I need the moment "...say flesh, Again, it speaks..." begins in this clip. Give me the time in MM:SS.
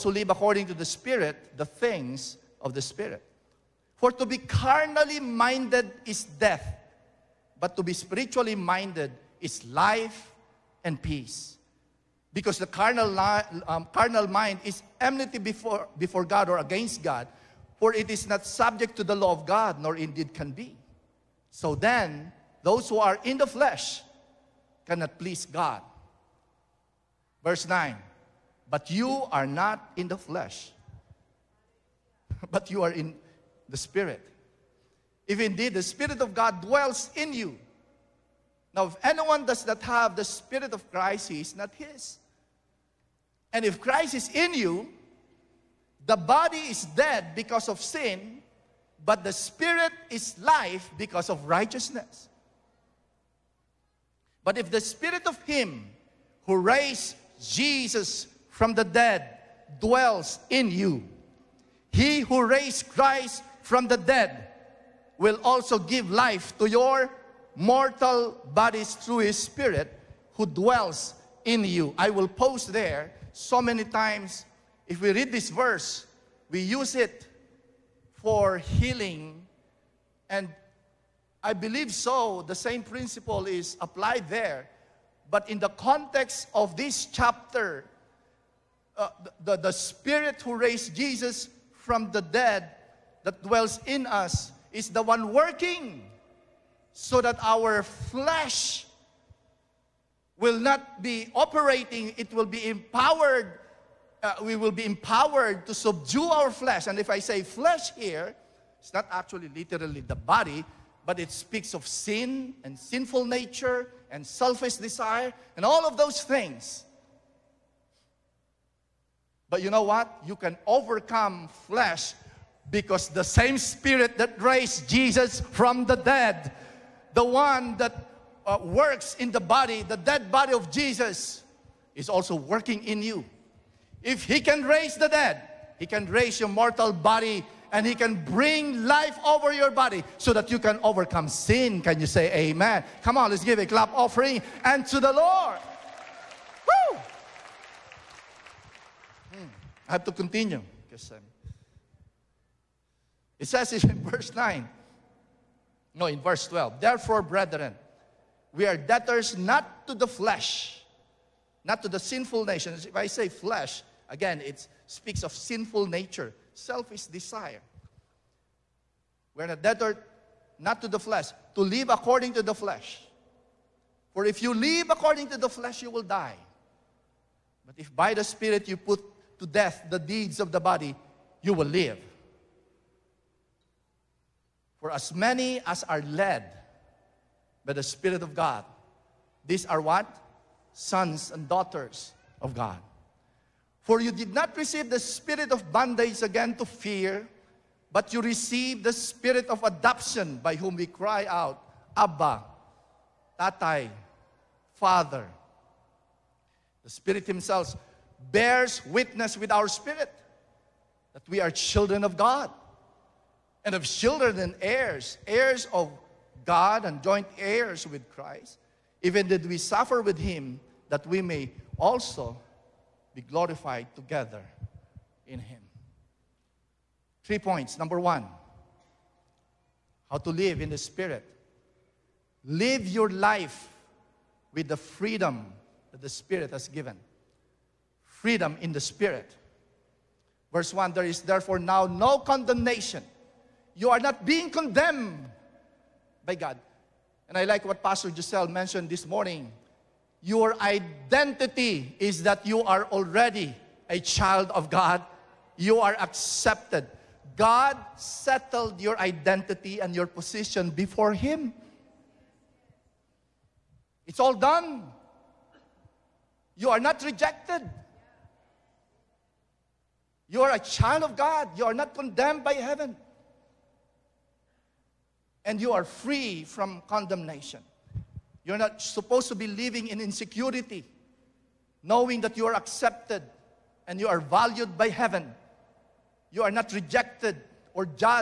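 02:43.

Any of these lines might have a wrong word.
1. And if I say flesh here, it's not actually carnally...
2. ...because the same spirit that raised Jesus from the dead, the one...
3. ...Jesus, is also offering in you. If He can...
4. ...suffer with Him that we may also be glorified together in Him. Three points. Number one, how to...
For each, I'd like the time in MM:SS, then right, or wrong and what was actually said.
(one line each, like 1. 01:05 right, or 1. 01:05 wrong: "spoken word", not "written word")
1. 01:46 wrong: "literally", not "carnally"
2. 02:02 right
3. 02:10 wrong: "working", not "offering"
4. 03:39 right.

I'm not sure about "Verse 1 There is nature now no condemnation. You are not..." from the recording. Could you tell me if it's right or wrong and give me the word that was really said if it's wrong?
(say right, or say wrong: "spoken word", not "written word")
wrong: "therefore", not "nature".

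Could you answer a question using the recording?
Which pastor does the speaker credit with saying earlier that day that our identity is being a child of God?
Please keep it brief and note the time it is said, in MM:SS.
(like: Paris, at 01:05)
Pastor Giselle, at 04:07.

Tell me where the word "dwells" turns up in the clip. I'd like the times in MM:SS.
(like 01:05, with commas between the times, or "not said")
00:36, 00:59, 01:10, 01:33.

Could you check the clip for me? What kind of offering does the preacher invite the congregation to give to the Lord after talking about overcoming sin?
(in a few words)
clap offering.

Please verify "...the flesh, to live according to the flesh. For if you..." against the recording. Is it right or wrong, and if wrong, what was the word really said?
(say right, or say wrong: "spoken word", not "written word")
right.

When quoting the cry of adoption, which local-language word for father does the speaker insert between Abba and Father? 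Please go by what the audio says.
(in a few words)
Tatay.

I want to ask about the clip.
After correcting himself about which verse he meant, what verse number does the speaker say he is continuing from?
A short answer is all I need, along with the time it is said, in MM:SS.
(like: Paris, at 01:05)
12, at 02:36.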